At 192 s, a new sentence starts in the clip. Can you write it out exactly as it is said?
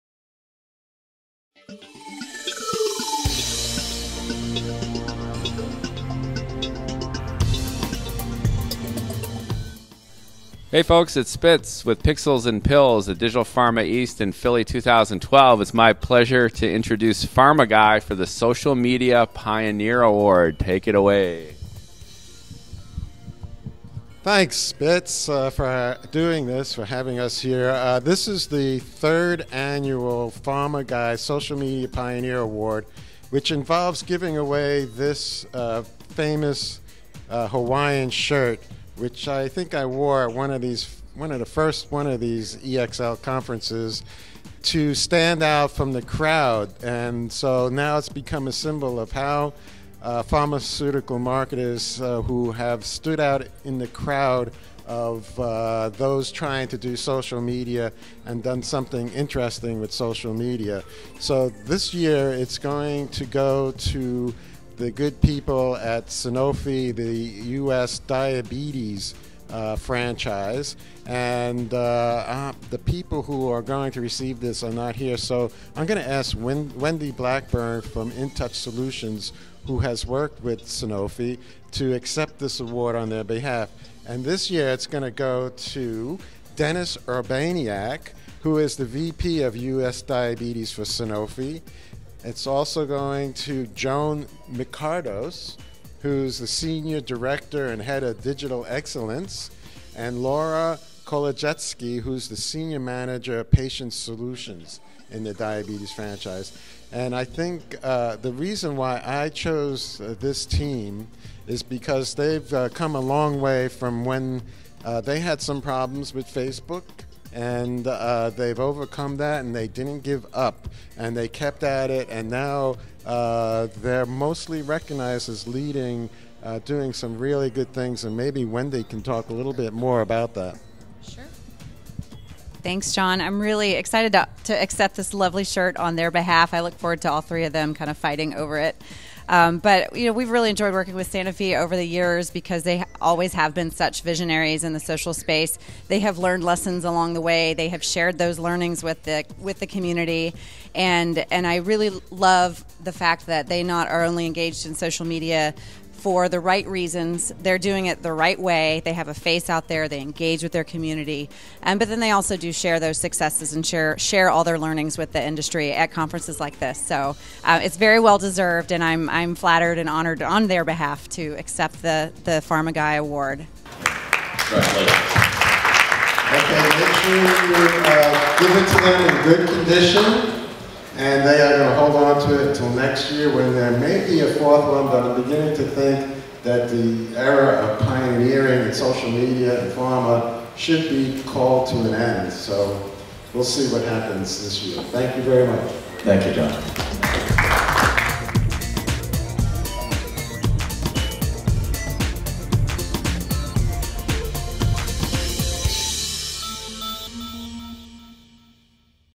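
So we'll see what happens this year.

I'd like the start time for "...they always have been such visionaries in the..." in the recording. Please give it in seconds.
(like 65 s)
142 s.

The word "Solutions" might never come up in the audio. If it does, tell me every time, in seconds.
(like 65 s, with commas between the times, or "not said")
78 s, 103 s.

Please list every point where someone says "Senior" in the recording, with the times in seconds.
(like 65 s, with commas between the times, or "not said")
96 s, 102 s.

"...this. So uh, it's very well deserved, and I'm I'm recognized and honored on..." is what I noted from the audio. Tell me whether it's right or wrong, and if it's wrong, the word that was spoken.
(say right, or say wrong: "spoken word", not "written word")
wrong: "flattered", not "recognized".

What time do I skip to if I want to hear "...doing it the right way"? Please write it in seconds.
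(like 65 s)
157 s.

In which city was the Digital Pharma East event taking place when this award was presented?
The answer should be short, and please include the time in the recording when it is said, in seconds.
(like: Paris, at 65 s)
Philly, at 14 s.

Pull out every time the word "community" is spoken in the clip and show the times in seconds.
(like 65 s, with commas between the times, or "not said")
149 s, 160 s.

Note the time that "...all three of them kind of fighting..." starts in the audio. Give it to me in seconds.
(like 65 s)
137 s.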